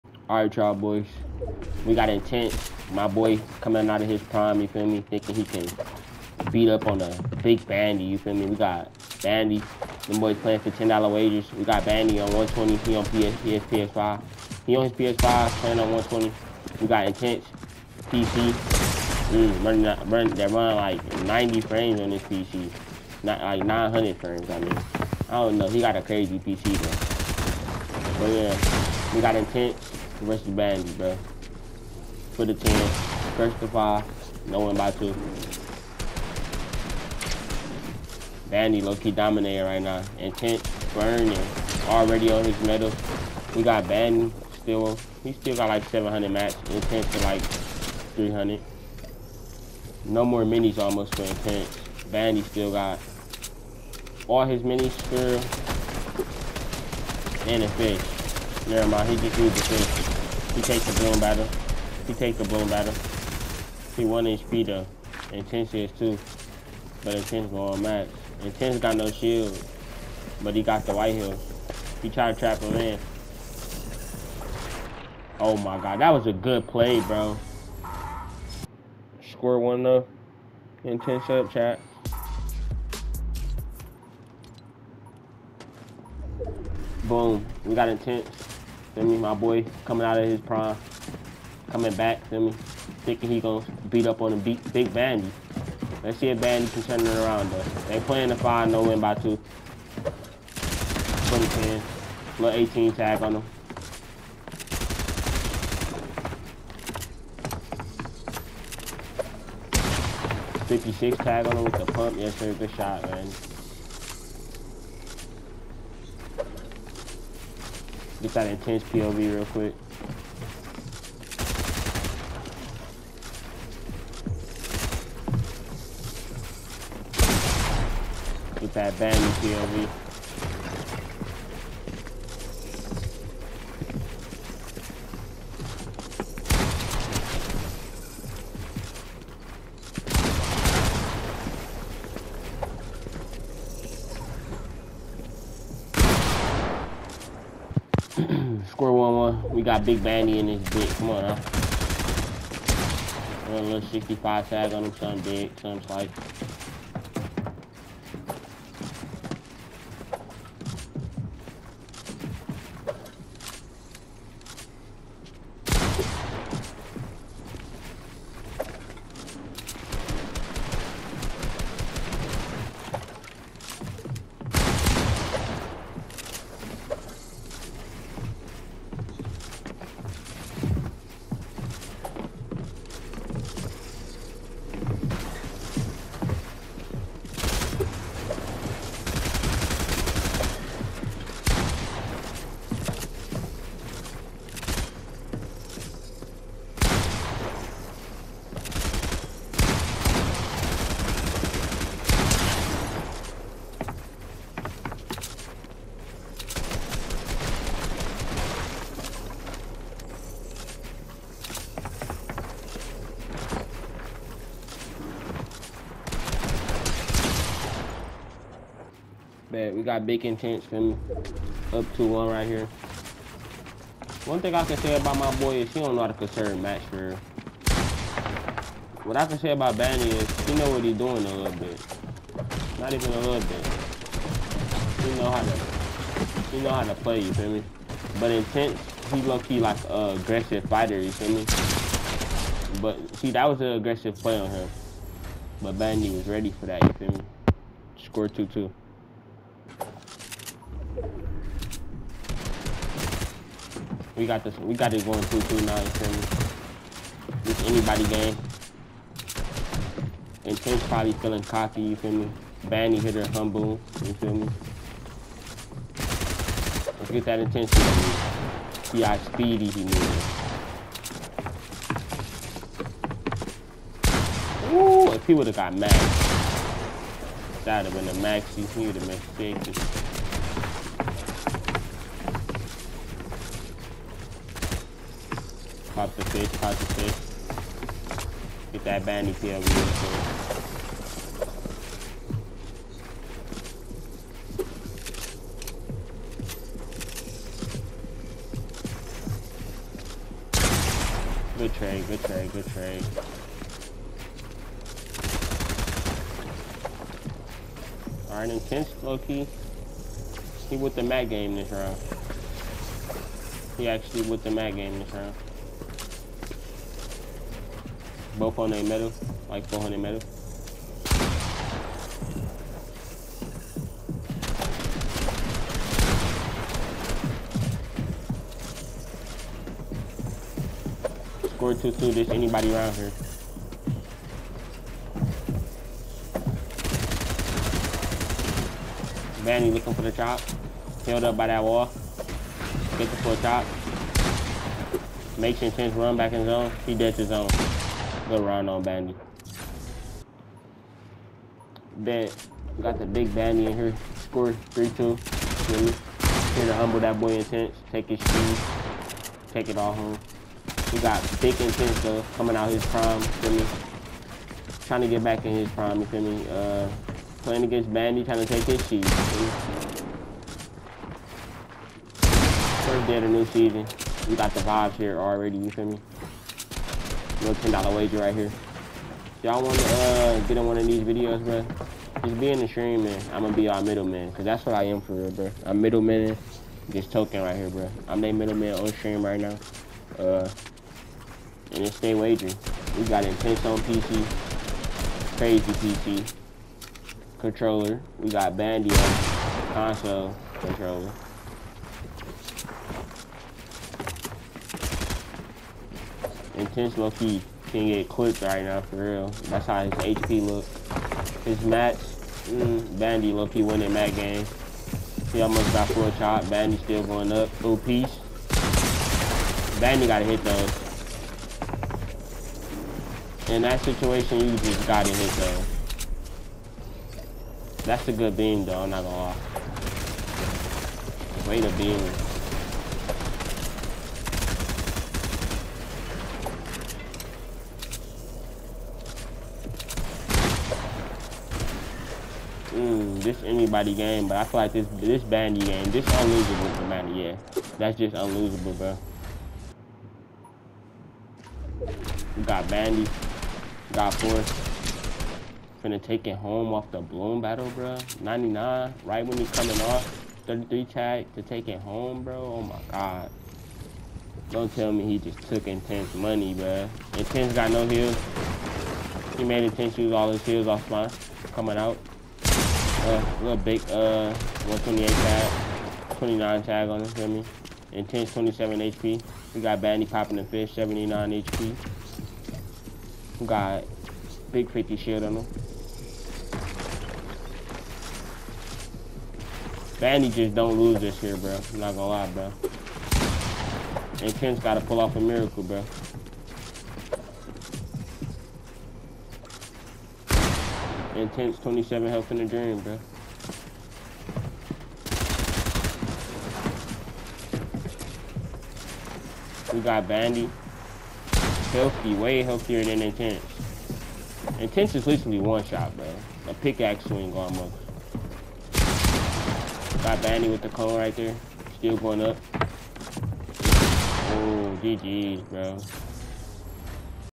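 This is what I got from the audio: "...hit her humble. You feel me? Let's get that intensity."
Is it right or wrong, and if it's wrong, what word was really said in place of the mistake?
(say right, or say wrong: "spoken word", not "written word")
right.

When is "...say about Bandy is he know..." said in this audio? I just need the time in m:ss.
3:49.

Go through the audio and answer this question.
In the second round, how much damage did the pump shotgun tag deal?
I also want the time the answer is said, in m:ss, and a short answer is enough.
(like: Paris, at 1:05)
56, at 1:50.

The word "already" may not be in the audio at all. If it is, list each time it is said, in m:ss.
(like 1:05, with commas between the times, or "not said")
0:41, 6:15.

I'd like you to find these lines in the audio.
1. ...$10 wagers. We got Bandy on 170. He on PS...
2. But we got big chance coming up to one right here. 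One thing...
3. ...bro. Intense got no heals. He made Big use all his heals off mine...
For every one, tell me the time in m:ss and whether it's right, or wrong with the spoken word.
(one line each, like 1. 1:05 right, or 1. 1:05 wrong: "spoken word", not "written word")
1. 0:10 wrong: "120", not "170"
2. 3:39 right
3. 7:46 wrong: "Intense", not "Big".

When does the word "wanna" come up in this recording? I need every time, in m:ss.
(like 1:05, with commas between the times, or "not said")
6:19.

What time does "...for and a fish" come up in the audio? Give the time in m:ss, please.
0:54.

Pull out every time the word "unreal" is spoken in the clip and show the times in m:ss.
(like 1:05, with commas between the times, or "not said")
not said.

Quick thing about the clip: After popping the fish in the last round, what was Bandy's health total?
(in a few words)
79.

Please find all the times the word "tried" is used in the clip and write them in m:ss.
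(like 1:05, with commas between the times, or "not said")
1:12.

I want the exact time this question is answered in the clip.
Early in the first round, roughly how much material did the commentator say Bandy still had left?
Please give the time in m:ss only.
0:45.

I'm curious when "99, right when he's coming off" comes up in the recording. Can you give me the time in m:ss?
7:38.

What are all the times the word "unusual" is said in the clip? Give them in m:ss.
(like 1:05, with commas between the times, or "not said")
not said.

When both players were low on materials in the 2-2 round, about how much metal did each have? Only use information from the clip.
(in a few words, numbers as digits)
400.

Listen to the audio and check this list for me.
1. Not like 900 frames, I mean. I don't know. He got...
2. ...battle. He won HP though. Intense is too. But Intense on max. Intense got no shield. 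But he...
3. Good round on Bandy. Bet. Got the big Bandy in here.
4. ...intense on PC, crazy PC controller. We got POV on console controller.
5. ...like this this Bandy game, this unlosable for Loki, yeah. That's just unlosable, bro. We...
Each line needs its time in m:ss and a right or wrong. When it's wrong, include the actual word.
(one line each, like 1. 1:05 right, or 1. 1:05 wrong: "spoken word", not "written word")
1. 0:23 right
2. 1:02 right
3. 5:48 right
4. 6:33 wrong: "Bandy", not "POV"
5. 7:24 wrong: "Bandy", not "Loki".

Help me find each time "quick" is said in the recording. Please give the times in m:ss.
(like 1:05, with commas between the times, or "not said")
1:59, 4:49.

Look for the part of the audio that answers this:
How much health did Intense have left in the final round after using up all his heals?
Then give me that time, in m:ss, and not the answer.
7:58.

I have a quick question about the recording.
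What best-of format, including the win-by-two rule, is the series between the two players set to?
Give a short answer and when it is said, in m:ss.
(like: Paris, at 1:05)
First of five, at 0:33.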